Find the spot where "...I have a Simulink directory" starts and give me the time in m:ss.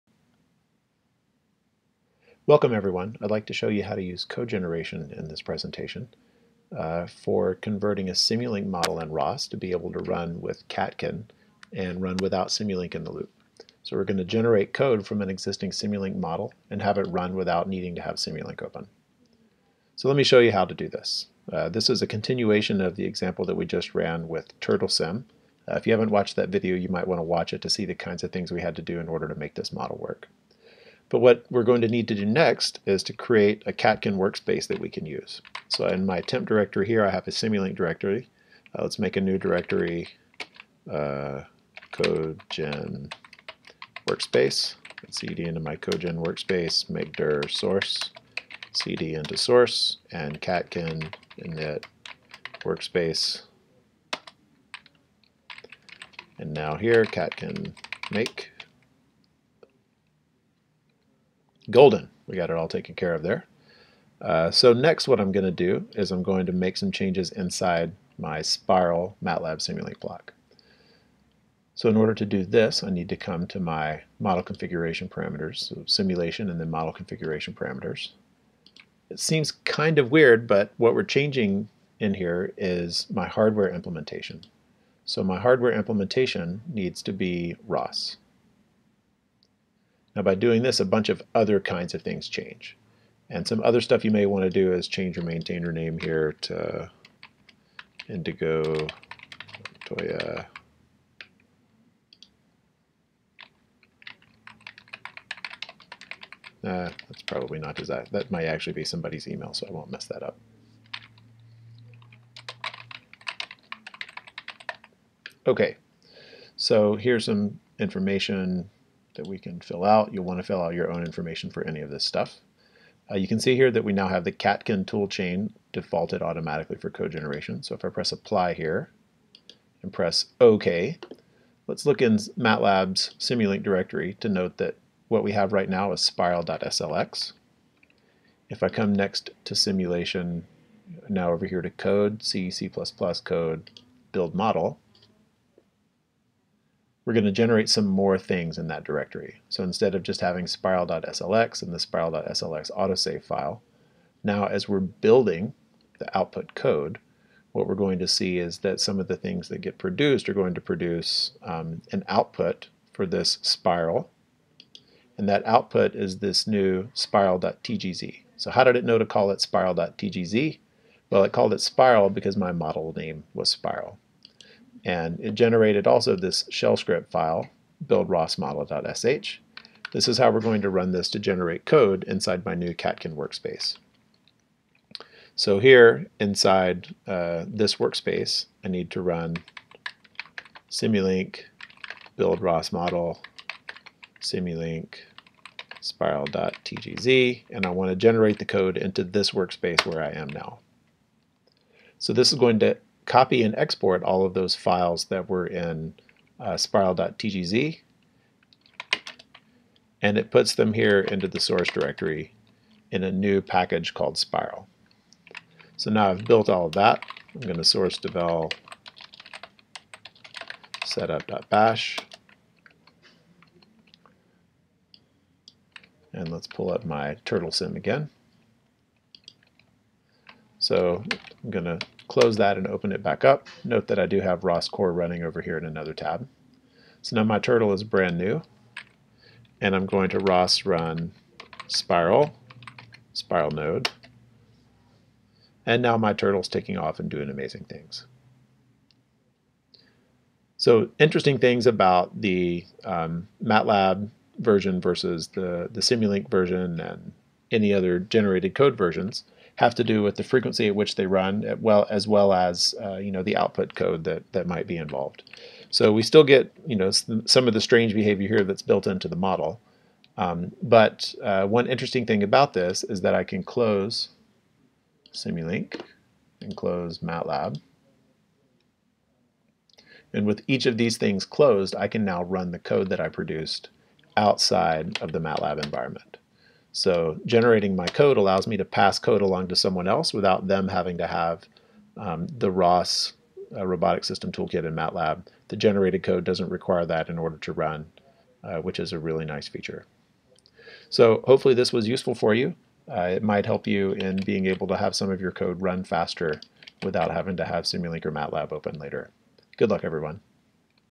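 0:37.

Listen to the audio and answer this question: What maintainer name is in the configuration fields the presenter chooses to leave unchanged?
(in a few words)
Indigo Toya.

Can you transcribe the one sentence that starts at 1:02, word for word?
We got it all taken care of there.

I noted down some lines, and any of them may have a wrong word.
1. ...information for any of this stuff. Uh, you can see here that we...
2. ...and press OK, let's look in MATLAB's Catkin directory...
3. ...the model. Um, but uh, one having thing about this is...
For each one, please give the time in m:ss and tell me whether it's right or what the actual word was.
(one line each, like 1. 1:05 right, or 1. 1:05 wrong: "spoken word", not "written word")
1. 2:01 right
2. 2:09 wrong: "Simulink", not "Catkin"
3. 4:29 wrong: "interesting", not "having".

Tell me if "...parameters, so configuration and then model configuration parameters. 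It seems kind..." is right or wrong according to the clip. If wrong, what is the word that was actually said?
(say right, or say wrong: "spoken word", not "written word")
wrong: "simulation", not "configuration".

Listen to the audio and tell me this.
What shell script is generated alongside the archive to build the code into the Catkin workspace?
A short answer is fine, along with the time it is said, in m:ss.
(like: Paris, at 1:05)
build_ros_model.sh, at 2:57.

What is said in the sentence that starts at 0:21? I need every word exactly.
Uh, this is a continuation of the example that we just ran with TurtleSim.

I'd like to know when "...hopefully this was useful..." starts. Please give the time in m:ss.
5:01.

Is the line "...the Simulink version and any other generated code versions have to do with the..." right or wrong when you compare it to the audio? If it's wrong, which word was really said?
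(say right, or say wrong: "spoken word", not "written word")
right.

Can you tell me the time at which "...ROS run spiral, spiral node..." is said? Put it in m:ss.
4:00.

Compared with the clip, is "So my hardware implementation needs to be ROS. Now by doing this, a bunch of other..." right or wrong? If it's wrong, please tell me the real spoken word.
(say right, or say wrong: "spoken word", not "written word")
right.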